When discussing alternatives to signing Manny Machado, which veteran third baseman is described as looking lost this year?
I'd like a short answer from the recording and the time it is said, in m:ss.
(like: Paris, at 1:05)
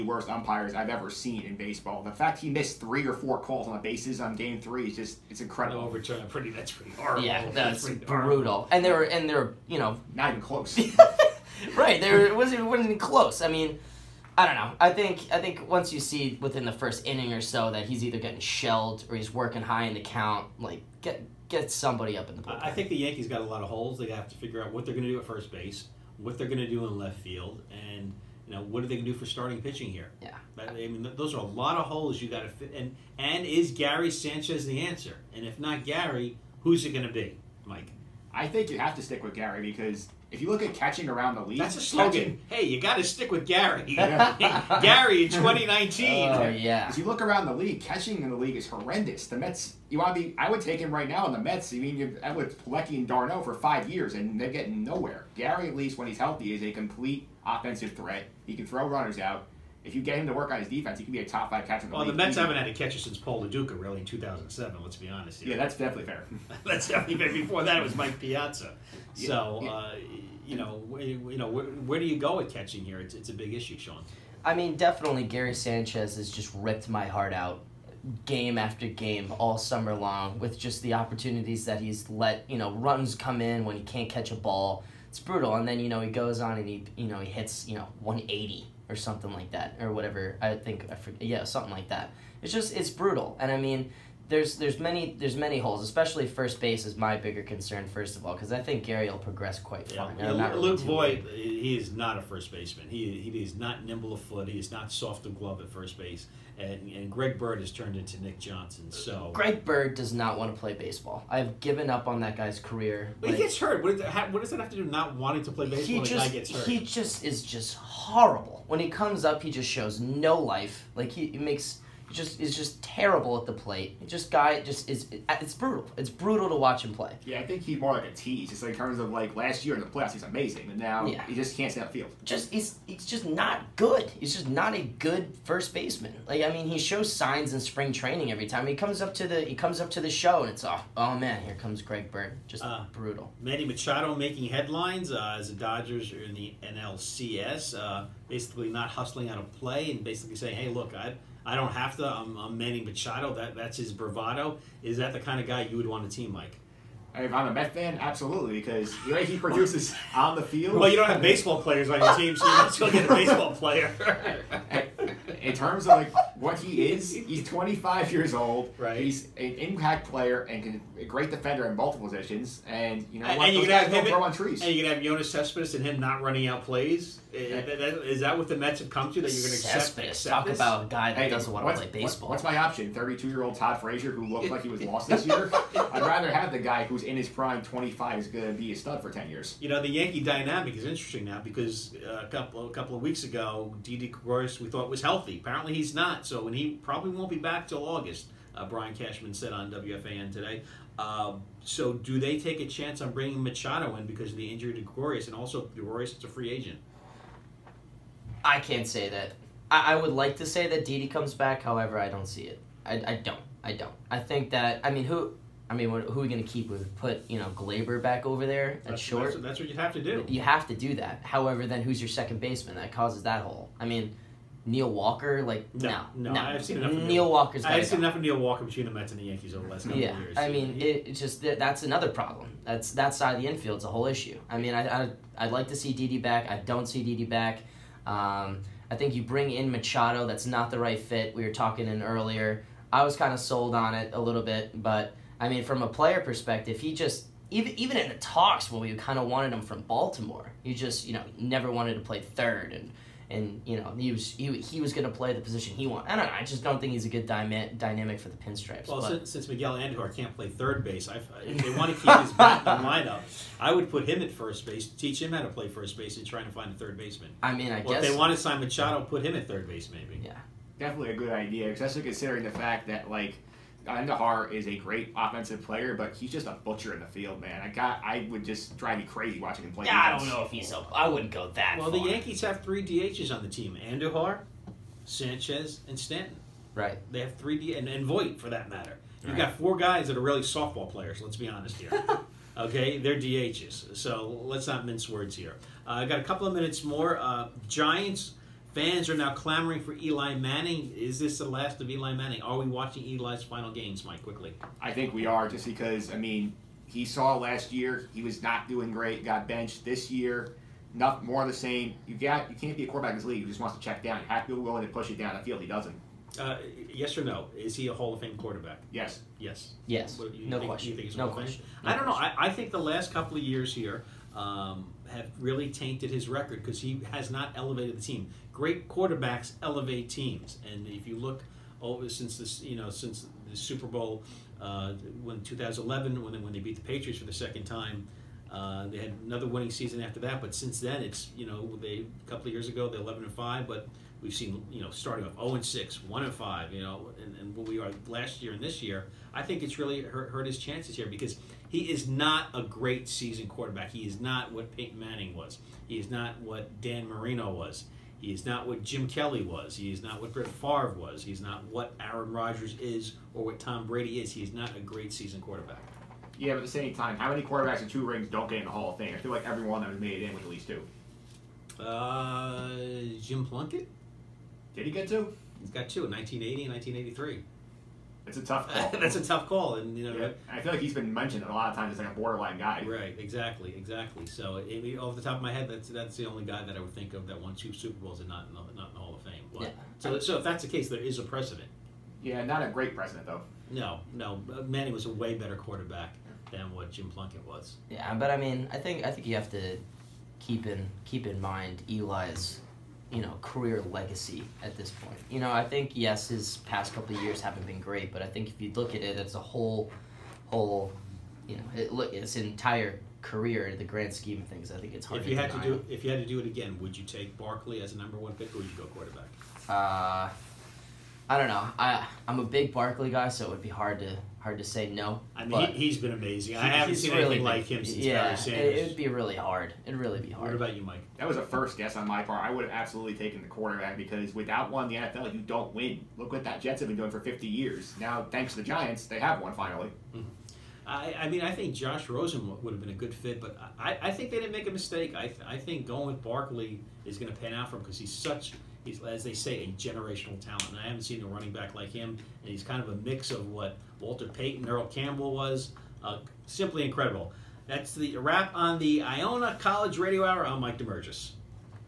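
Todd Frazier, at 3:03.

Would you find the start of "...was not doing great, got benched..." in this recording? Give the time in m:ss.
5:08.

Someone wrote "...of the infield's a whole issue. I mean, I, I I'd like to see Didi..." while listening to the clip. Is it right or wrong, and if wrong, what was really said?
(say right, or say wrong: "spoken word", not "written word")
right.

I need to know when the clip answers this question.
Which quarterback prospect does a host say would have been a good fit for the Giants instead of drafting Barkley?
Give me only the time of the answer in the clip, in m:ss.
7:21.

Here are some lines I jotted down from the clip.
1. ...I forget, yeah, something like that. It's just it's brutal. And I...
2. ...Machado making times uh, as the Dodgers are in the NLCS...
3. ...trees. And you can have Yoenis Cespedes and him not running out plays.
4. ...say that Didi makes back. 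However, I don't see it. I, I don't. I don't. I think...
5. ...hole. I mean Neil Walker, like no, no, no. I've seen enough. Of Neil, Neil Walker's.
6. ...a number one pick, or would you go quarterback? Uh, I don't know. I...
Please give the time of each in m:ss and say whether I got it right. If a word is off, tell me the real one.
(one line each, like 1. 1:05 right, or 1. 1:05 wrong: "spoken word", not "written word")
1. 1:30 right
2. 2:23 wrong: "headlines", not "times"
3. 2:54 right
4. 3:30 wrong: "comes", not "makes"
5. 3:43 right
6. 6:57 right.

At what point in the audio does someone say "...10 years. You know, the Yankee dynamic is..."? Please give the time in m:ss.
3:09.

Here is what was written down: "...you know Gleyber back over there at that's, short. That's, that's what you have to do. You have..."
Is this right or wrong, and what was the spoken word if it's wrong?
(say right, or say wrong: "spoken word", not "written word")
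right.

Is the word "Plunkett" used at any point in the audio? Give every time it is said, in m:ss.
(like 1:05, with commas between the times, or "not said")
6:13, 6:37.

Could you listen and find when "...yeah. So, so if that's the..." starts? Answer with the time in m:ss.
6:29.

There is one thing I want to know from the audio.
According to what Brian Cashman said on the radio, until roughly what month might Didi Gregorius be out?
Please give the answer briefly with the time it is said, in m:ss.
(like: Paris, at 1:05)
August, at 3:17.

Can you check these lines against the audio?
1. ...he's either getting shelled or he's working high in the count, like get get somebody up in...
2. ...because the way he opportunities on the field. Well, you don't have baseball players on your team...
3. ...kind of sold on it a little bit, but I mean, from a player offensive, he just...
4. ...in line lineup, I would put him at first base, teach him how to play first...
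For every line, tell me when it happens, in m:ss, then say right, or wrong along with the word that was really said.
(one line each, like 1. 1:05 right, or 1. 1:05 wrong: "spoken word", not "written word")
1. 0:17 right
2. 2:38 wrong: "produces", not "opportunities"
3. 4:03 wrong: "perspective", not "offensive"
4. 4:22 right.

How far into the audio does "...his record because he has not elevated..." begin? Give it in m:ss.
5:26.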